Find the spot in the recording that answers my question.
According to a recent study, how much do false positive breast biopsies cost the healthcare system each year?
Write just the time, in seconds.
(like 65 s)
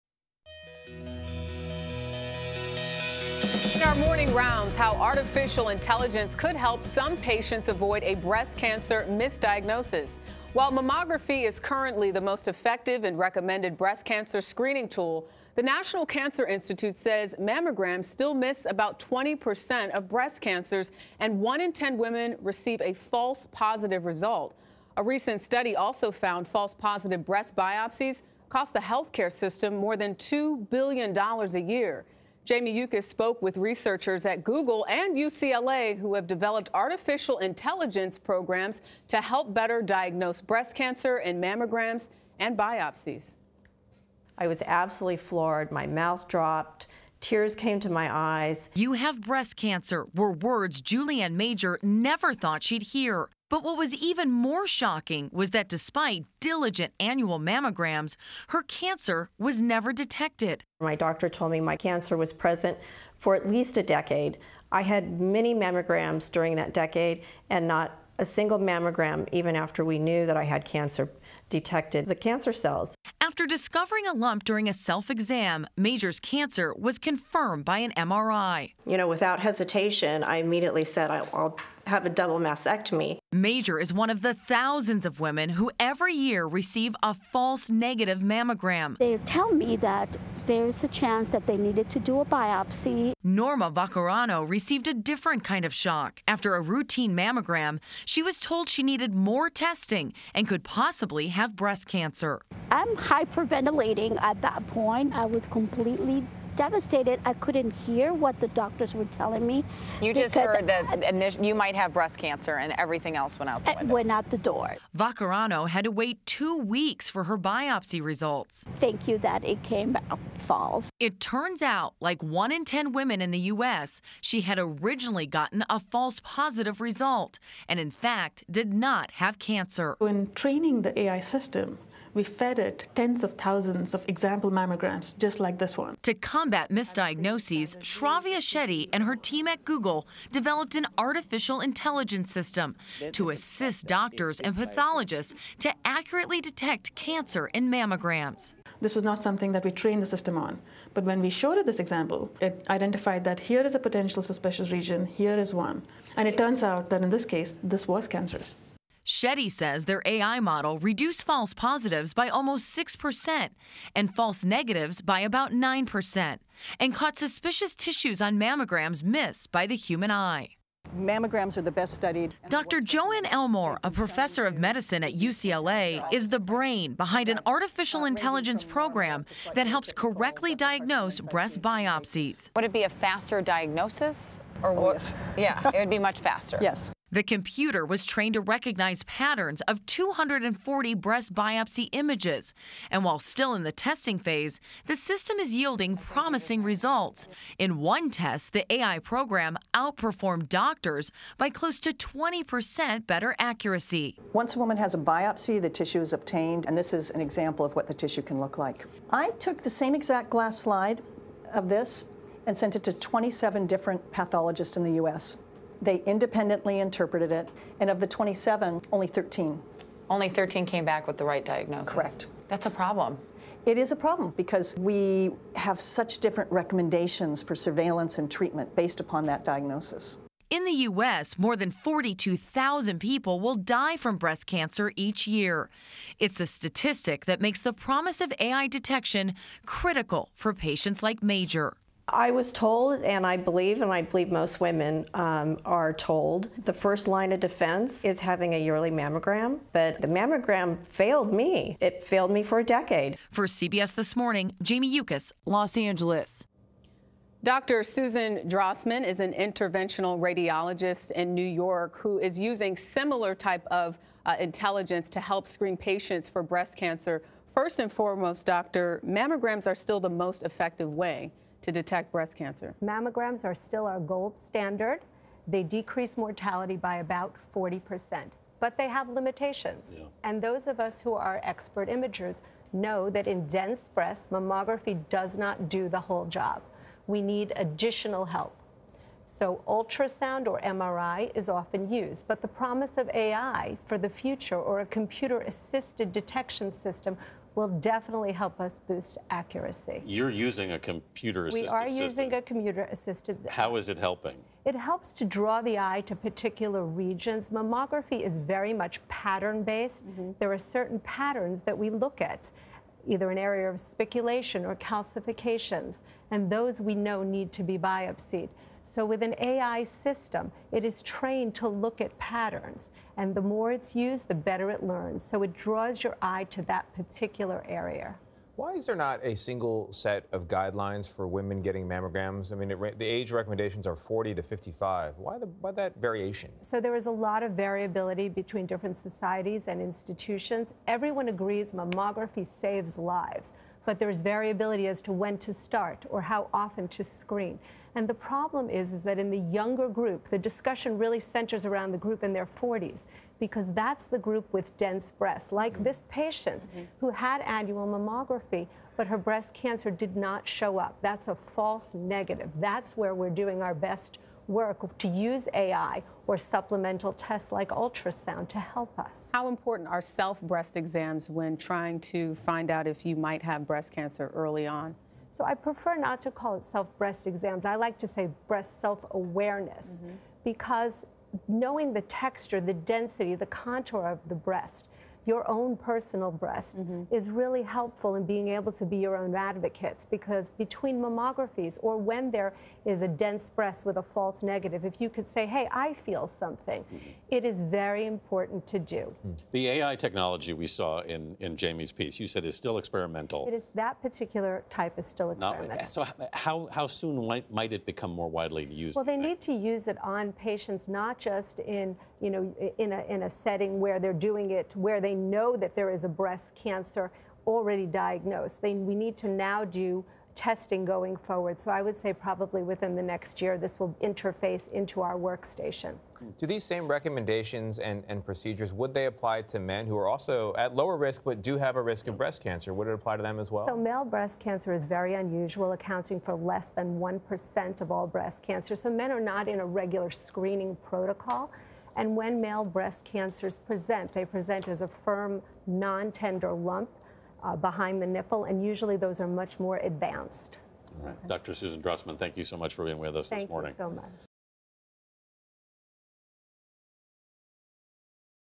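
30 s.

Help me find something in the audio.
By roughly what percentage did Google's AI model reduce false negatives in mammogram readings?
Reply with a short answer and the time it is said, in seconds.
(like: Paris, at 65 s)
about 9%, at 165 s.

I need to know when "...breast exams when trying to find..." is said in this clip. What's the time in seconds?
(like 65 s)
370 s.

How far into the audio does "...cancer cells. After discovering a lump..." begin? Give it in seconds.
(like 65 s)
72 s.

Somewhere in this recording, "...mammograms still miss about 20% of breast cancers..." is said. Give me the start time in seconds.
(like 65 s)
17 s.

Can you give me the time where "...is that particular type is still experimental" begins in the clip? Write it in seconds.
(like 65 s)
403 s.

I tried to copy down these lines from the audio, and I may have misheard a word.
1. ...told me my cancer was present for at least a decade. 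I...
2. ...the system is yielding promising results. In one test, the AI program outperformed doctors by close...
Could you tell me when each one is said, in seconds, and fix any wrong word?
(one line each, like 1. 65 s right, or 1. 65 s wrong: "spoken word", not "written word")
1. 61 s right
2. 194 s right.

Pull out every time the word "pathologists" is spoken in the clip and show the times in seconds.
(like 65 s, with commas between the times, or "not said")
144 s, 214 s.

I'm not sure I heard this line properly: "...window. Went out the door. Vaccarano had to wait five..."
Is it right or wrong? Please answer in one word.
wrong.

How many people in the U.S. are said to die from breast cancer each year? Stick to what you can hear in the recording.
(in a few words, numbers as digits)
more than 42,000.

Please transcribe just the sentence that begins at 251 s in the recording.
It failed me for a decade.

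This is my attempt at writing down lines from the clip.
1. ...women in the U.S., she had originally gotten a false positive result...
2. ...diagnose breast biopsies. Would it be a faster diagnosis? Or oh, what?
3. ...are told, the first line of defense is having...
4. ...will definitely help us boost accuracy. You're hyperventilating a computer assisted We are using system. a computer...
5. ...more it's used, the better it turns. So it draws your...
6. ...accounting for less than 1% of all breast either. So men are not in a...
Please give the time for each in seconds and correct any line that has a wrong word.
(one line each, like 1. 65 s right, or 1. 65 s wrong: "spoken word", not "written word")
1. 122 s right
2. 180 s right
3. 245 s right
4. 297 s wrong: "using", not "hyperventilating"
5. 323 s wrong: "learns", not "turns"
6. 435 s wrong: "cancer", not "either".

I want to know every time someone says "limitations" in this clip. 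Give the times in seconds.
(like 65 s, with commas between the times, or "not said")
279 s.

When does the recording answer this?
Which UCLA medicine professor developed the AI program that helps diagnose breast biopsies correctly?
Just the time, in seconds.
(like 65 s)
172 s.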